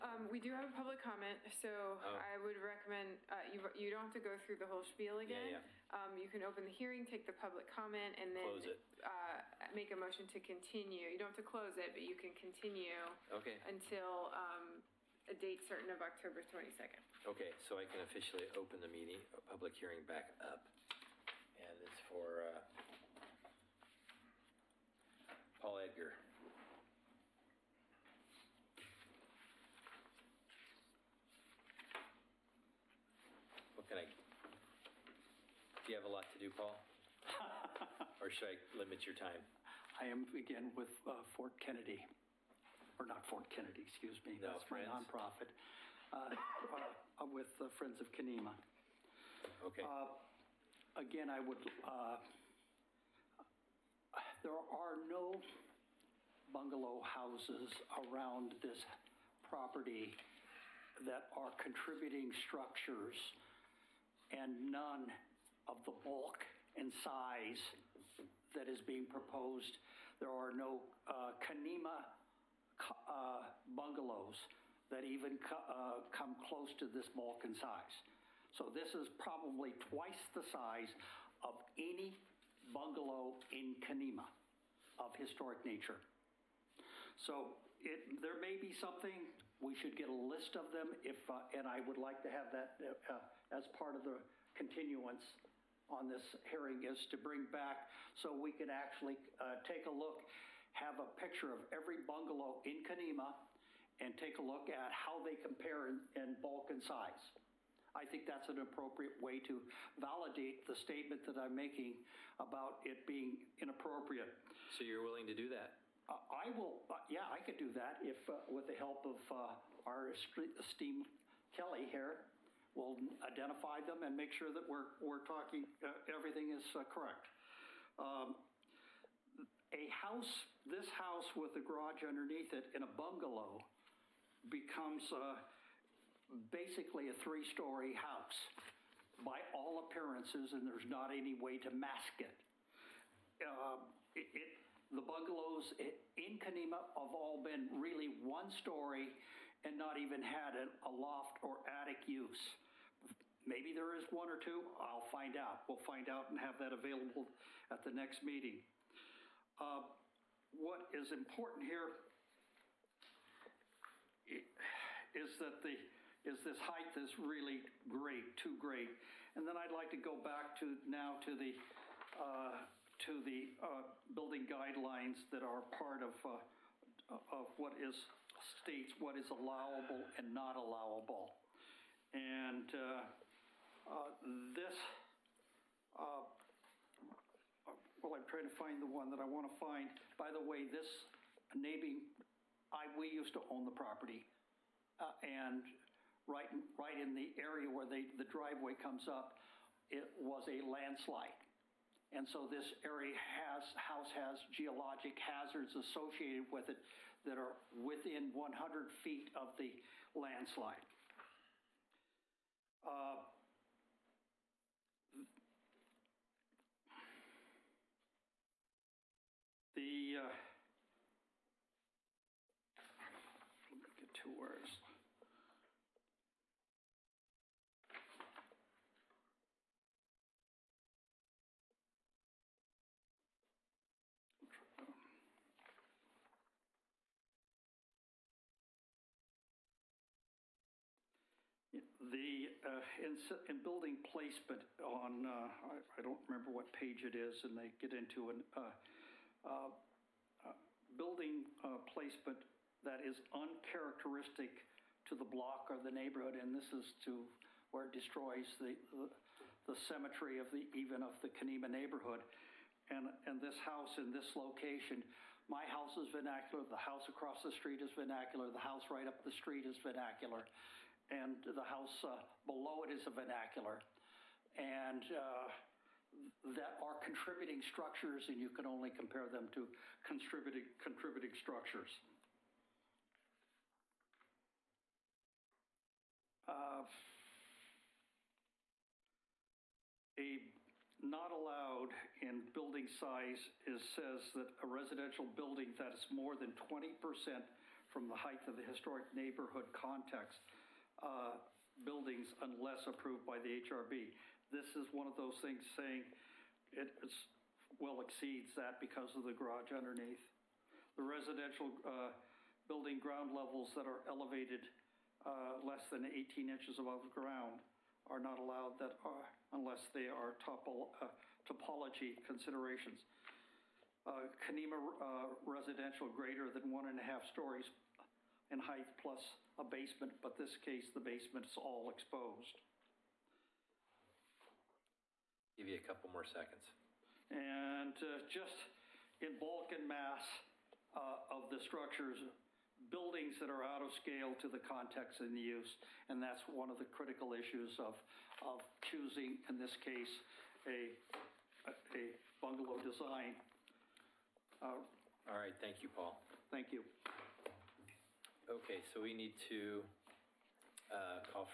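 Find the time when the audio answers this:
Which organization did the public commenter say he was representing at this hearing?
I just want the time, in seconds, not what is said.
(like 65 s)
47 s.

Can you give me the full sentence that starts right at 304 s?
This is one of those things saying it it's, well exceeds that because of the garage underneath.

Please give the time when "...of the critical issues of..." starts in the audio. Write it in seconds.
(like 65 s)
346 s.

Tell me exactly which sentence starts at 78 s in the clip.
So this is probably twice the size of any bungalow in Canemah of historic nature.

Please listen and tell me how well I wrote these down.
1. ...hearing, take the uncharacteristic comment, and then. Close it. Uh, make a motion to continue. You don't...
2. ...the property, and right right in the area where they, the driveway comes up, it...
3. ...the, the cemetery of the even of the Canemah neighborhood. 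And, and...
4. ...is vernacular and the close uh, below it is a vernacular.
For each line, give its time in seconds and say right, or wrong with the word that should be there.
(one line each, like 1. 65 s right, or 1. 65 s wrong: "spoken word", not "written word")
1. 6 s wrong: "public", not "uncharacteristic"
2. 193 s right
3. 258 s right
4. 269 s wrong: "house", not "close".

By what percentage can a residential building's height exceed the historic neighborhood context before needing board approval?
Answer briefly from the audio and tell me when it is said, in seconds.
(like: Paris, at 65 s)
20%, at 296 s.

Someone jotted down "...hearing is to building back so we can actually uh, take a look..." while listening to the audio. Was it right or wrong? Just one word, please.
wrong.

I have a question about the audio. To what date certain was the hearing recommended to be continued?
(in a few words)
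October 22.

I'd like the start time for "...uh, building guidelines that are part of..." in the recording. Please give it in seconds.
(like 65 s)
173 s.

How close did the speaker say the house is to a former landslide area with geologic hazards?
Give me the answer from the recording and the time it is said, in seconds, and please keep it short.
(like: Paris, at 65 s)
100 feet, at 208 s.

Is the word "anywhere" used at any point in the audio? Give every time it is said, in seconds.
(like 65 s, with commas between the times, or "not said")
not said.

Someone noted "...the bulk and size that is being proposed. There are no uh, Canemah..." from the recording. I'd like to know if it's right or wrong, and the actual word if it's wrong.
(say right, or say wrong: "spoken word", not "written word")
right.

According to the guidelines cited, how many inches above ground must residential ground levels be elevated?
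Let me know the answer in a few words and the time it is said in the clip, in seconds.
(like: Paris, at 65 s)
18 inches, at 316 s.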